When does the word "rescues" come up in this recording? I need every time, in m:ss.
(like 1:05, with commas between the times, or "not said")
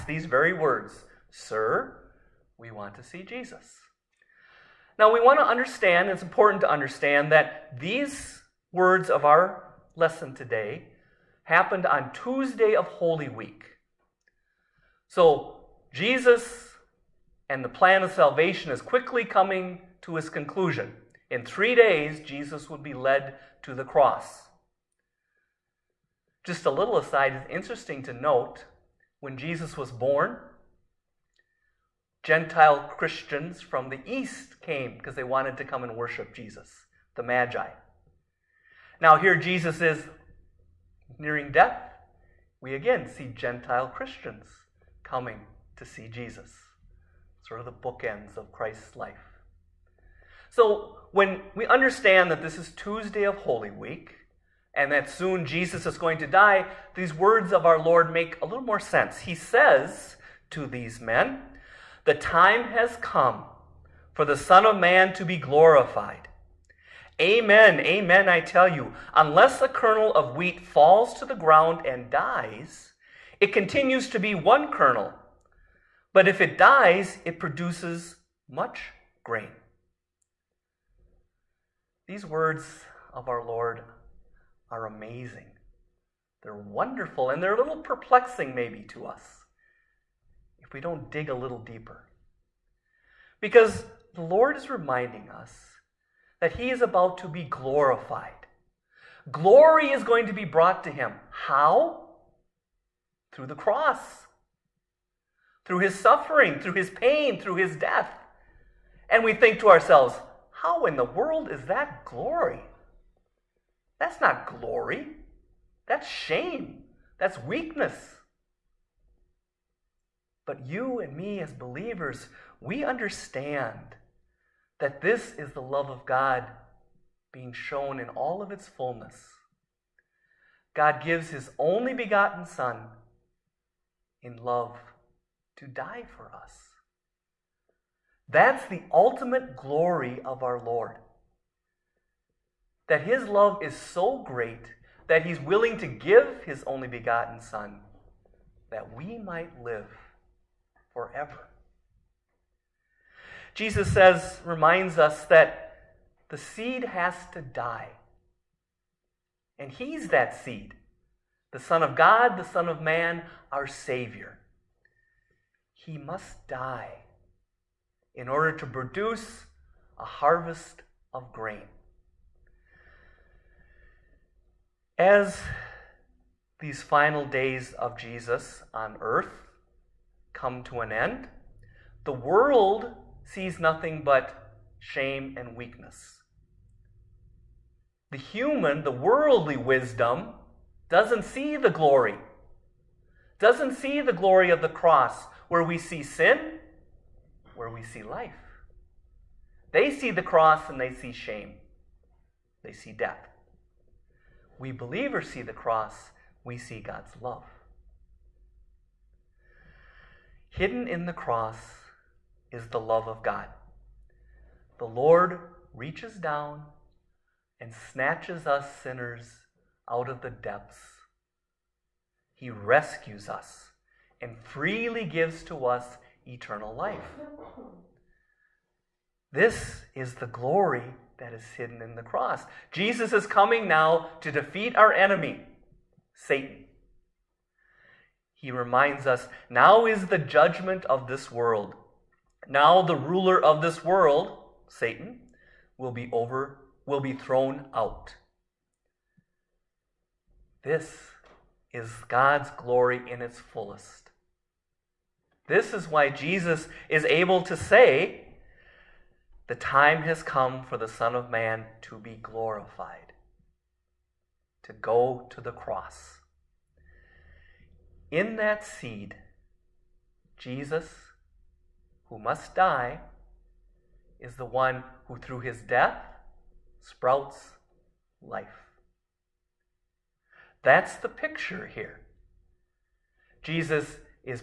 3:42.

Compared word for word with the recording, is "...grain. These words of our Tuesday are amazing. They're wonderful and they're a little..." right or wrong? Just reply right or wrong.
wrong.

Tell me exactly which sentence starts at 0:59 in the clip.
He says to these men, The time has come for the Son of Man to be glorified.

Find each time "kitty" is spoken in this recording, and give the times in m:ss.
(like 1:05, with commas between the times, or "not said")
not said.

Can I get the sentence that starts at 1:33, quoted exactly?
Because the Lord is reminding us that He is about to be glorified.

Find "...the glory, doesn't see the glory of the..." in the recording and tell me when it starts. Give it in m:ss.
3:11.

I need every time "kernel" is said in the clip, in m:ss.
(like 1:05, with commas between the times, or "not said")
1:09, 1:14.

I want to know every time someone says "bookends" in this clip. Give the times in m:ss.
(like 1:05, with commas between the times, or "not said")
0:47.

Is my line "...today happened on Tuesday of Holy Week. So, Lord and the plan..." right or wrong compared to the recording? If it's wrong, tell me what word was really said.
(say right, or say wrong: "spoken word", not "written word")
wrong: "Jesus", not "Lord".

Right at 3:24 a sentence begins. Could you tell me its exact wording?
We believers see the cross, we see God's love.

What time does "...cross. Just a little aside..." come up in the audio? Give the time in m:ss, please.
0:23.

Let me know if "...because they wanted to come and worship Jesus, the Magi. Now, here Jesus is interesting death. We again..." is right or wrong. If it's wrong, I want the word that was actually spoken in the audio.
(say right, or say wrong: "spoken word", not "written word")
wrong: "nearing", not "interesting".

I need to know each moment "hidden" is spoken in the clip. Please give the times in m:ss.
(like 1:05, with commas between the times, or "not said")
3:30, 3:51.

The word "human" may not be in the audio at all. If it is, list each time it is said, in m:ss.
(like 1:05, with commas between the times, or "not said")
3:08.